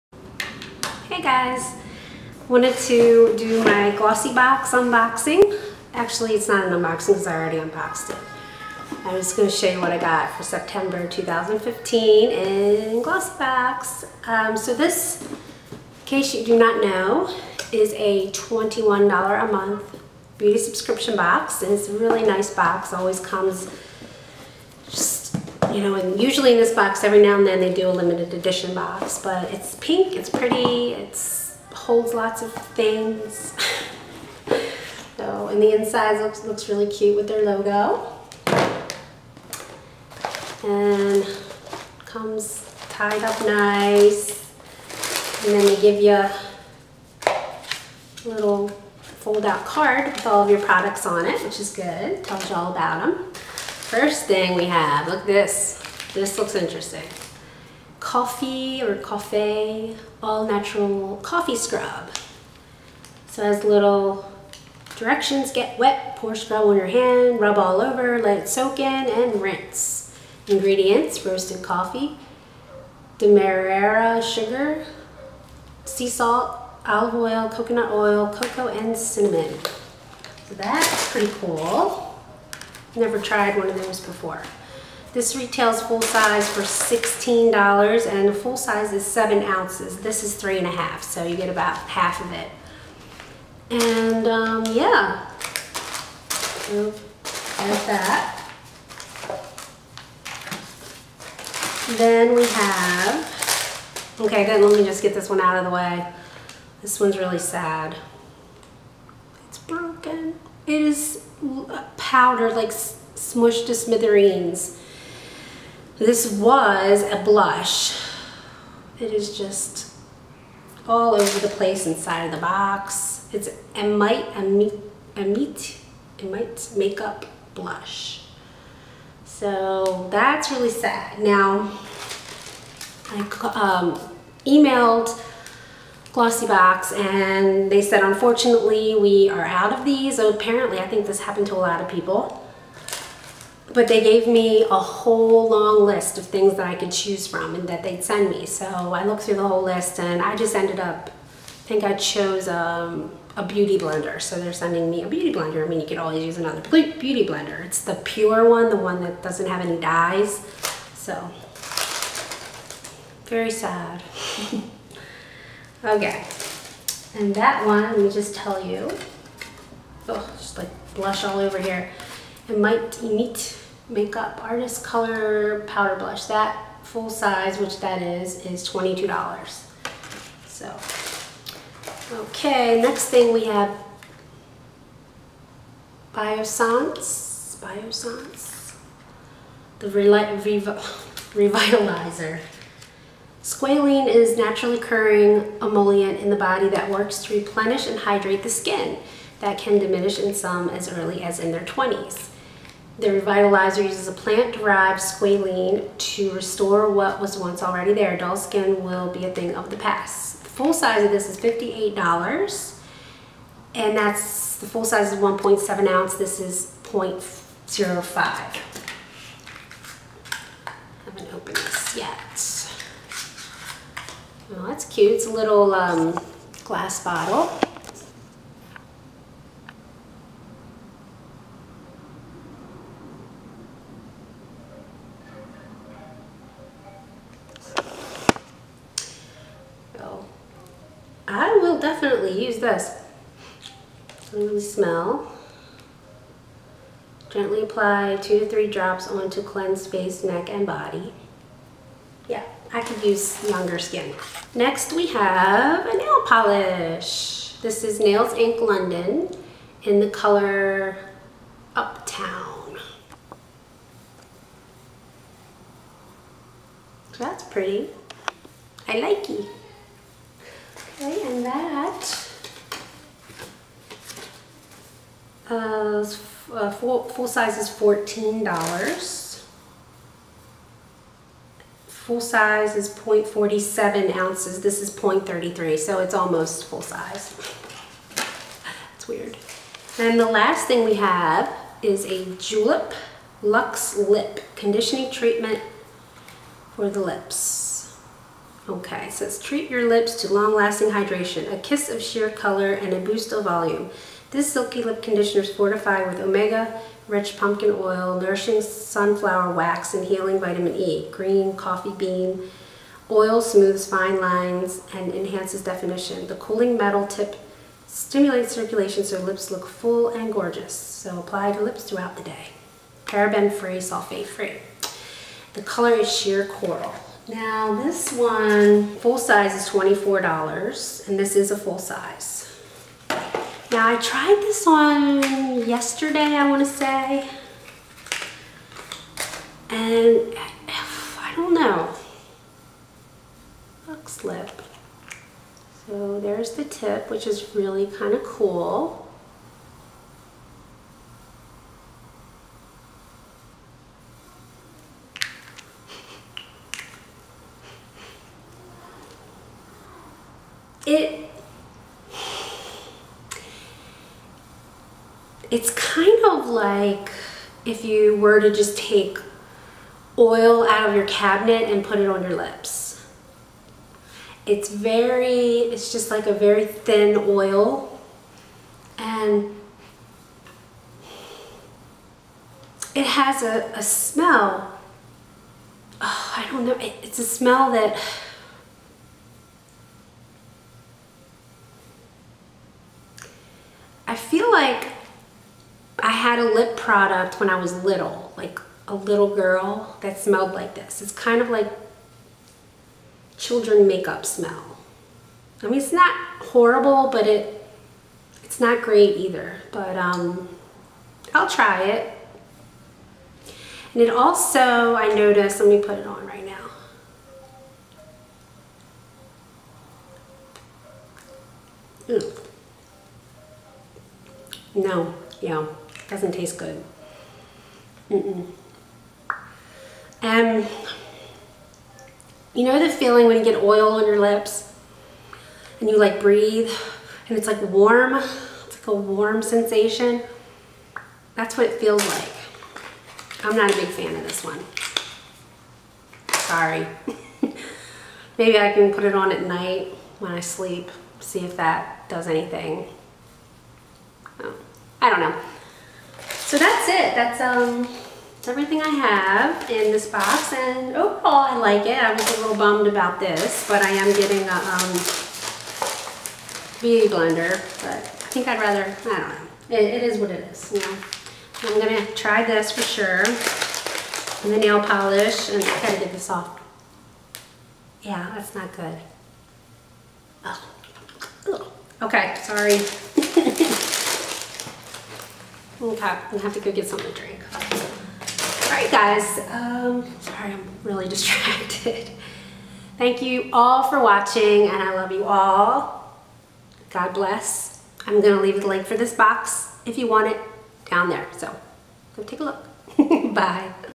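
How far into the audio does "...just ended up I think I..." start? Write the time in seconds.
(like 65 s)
150 s.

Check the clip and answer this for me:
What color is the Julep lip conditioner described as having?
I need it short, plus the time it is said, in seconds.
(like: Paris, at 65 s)
sheer coral, at 326 s.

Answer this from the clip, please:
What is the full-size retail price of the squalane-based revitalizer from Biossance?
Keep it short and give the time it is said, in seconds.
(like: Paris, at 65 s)
$58, at 211 s.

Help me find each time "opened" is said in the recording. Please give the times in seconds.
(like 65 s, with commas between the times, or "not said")
221 s.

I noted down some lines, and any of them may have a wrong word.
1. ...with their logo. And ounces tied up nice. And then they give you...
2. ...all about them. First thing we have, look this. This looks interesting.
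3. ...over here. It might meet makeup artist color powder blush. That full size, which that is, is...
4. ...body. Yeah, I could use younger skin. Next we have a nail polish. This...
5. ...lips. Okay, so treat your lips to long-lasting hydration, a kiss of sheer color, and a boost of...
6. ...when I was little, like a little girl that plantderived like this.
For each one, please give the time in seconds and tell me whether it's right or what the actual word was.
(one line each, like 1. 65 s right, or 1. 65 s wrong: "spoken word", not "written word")
1. 37 s wrong: "comes", not "ounces"
2. 52 s right
3. 171 s right
4. 250 s right
5. 296 s right
6. 397 s wrong: "smelled", not "plantderived".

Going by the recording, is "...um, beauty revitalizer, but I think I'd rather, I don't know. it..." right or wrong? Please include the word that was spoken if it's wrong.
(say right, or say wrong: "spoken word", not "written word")
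wrong: "blender", not "revitalizer".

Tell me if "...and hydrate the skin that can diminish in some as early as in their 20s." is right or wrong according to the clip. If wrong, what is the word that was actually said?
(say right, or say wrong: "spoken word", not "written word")
right.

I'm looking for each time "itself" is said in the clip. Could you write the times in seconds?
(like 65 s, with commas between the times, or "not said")
not said.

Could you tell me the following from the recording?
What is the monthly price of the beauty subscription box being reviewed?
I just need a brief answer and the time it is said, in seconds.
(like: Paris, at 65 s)
$21, at 18 s.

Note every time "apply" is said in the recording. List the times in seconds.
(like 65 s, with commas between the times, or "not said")
247 s, 321 s.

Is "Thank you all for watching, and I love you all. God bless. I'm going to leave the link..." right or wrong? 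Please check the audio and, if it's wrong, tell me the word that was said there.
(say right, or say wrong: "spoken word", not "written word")
right.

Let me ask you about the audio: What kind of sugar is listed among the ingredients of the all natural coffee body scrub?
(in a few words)
demerara sugar.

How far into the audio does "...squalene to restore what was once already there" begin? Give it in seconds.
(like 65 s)
205 s.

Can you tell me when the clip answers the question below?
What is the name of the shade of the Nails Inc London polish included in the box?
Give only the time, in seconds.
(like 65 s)
261 s.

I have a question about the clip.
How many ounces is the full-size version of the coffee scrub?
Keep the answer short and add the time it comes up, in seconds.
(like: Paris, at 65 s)
7 ounces, at 89 s.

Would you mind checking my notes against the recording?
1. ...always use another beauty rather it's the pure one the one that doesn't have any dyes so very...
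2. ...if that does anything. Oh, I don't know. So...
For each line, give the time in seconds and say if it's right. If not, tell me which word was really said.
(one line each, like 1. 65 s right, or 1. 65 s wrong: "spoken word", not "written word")
1. 155 s wrong: "blender", not "rather"
2. 451 s right.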